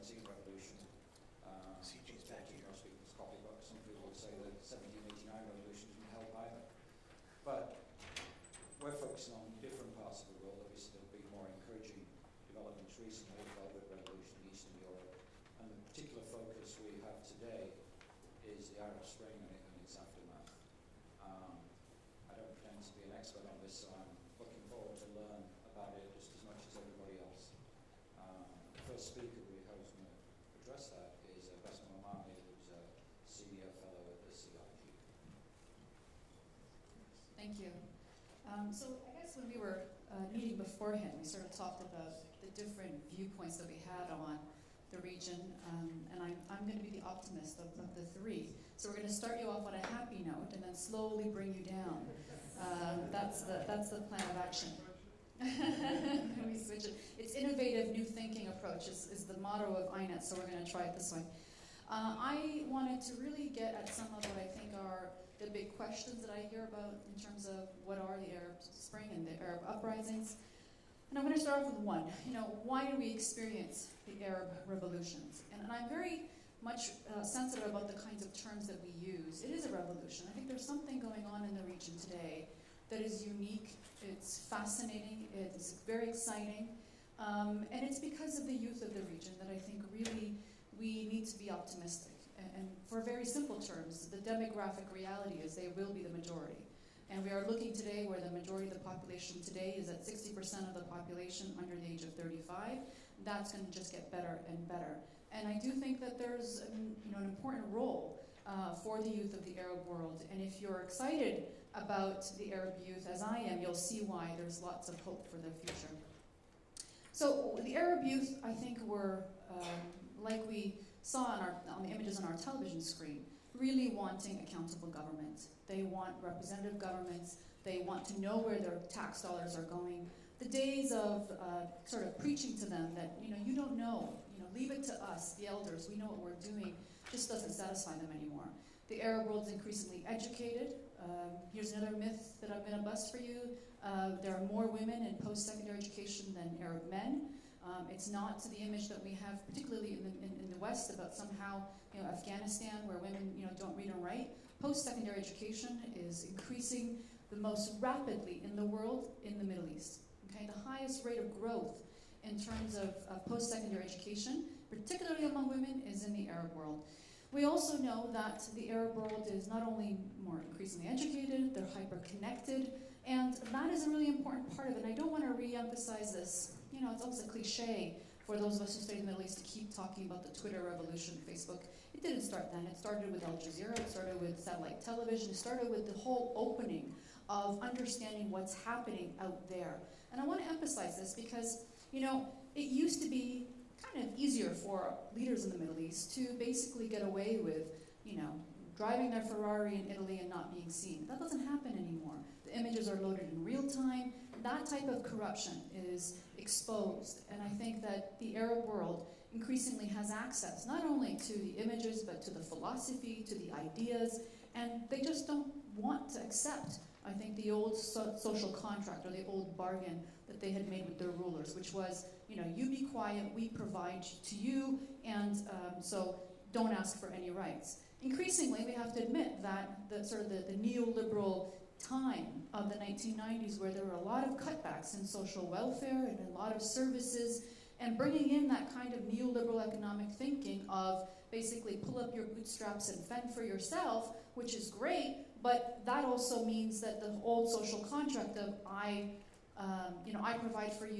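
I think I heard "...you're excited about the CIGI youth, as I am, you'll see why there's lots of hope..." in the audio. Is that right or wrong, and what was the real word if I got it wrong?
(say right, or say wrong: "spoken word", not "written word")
wrong: "Arab", not "CIGI".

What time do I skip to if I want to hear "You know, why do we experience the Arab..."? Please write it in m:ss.
1:12.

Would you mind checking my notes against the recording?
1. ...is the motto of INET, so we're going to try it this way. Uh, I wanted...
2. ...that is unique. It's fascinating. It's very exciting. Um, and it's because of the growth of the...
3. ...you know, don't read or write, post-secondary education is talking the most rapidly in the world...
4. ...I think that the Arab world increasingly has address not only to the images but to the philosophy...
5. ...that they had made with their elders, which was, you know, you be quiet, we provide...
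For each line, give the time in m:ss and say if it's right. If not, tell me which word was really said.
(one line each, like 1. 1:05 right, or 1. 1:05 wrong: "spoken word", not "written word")
1. 0:59 right
2. 1:22 wrong: "youth", not "growth"
3. 2:33 wrong: "increasing", not "talking"
4. 3:27 wrong: "access", not "address"
5. 3:40 wrong: "rulers", not "elders".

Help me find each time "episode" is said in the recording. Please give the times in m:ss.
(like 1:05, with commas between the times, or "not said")
not said.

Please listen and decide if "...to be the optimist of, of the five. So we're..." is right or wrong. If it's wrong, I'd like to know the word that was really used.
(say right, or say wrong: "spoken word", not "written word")
wrong: "three", not "five".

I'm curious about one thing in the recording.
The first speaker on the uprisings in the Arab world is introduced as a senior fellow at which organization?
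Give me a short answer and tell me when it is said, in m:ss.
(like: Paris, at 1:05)
CIGI, at 0:34.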